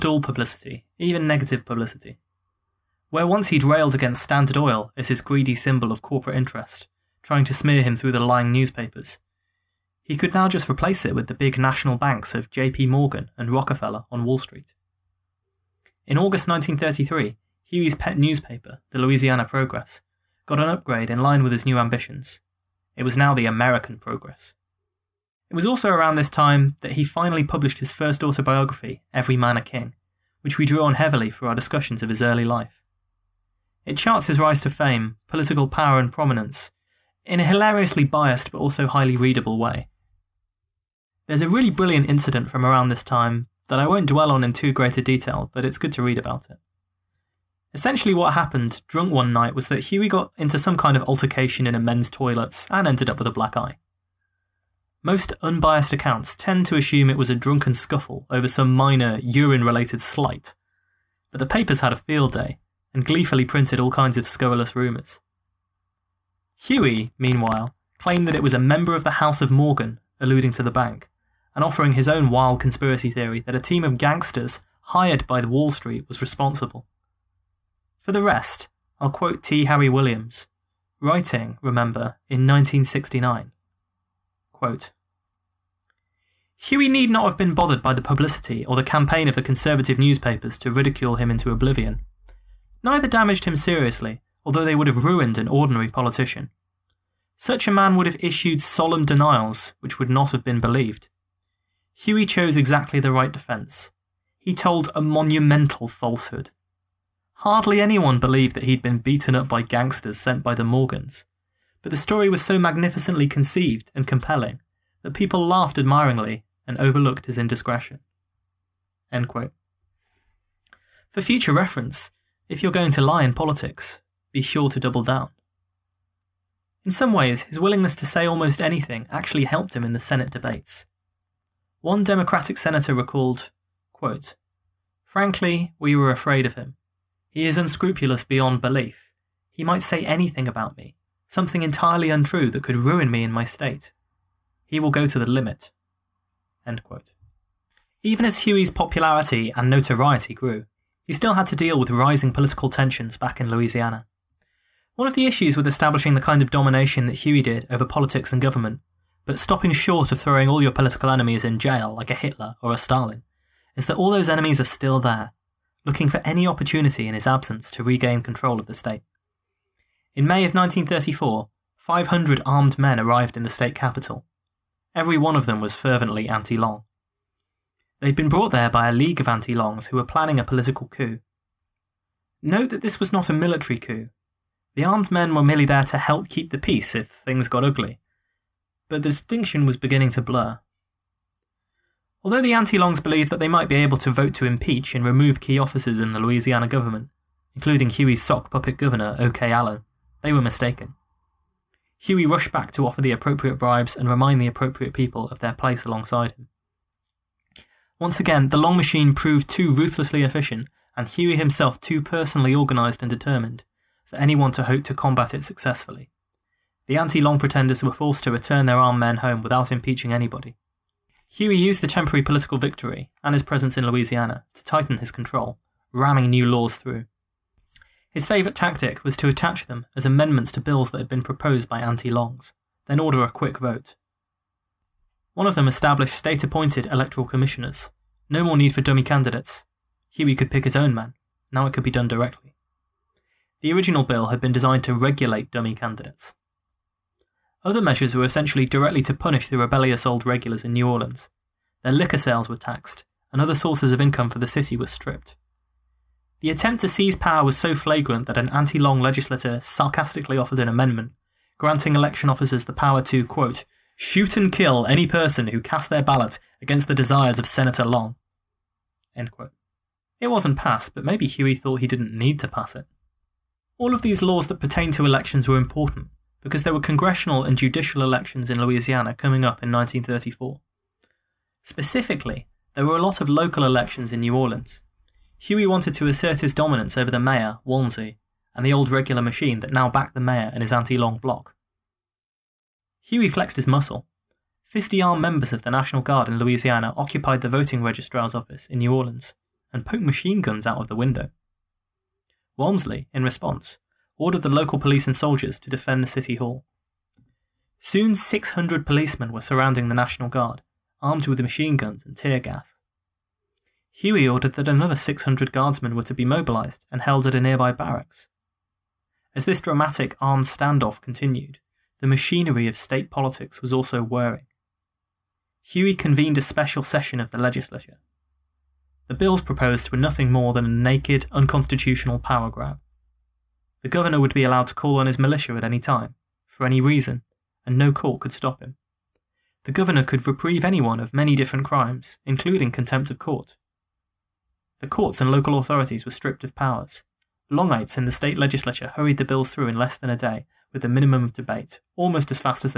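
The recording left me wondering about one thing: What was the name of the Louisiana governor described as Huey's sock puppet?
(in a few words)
O.K. Allen.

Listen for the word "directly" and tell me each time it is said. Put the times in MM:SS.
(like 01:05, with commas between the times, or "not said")
04:02, 04:08.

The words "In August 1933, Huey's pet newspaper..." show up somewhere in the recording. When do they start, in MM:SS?
00:16.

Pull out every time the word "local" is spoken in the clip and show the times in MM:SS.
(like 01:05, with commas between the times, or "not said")
04:43, 05:04, 05:45.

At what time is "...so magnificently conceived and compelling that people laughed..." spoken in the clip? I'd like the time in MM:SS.
01:52.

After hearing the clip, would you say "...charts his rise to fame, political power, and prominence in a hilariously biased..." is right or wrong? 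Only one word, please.
right.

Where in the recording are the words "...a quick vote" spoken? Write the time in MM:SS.
03:53.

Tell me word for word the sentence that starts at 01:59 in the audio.
For future reference, if you're going to lie in politics, be sure to double down.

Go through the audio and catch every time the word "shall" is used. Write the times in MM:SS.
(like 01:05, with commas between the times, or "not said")
not said.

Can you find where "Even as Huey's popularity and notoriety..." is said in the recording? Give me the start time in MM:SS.
02:28.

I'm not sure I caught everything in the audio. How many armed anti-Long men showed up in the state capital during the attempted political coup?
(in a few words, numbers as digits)
500.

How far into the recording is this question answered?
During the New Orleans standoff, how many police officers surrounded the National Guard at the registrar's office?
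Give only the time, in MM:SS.
05:08.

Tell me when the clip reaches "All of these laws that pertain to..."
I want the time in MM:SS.
04:33.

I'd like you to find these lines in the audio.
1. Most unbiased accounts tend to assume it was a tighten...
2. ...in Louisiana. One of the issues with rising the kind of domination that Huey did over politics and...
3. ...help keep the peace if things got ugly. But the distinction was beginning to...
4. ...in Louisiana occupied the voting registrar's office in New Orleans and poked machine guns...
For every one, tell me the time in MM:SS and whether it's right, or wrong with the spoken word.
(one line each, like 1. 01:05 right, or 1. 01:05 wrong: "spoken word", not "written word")
1. 00:55 wrong: "drunken", not "tighten"
2. 02:33 wrong: "establishing", not "rising"
3. 03:05 right
4. 04:56 right.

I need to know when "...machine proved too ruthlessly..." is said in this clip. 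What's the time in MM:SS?
03:28.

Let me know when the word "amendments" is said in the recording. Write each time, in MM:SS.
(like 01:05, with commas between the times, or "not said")
03:50, 04:20.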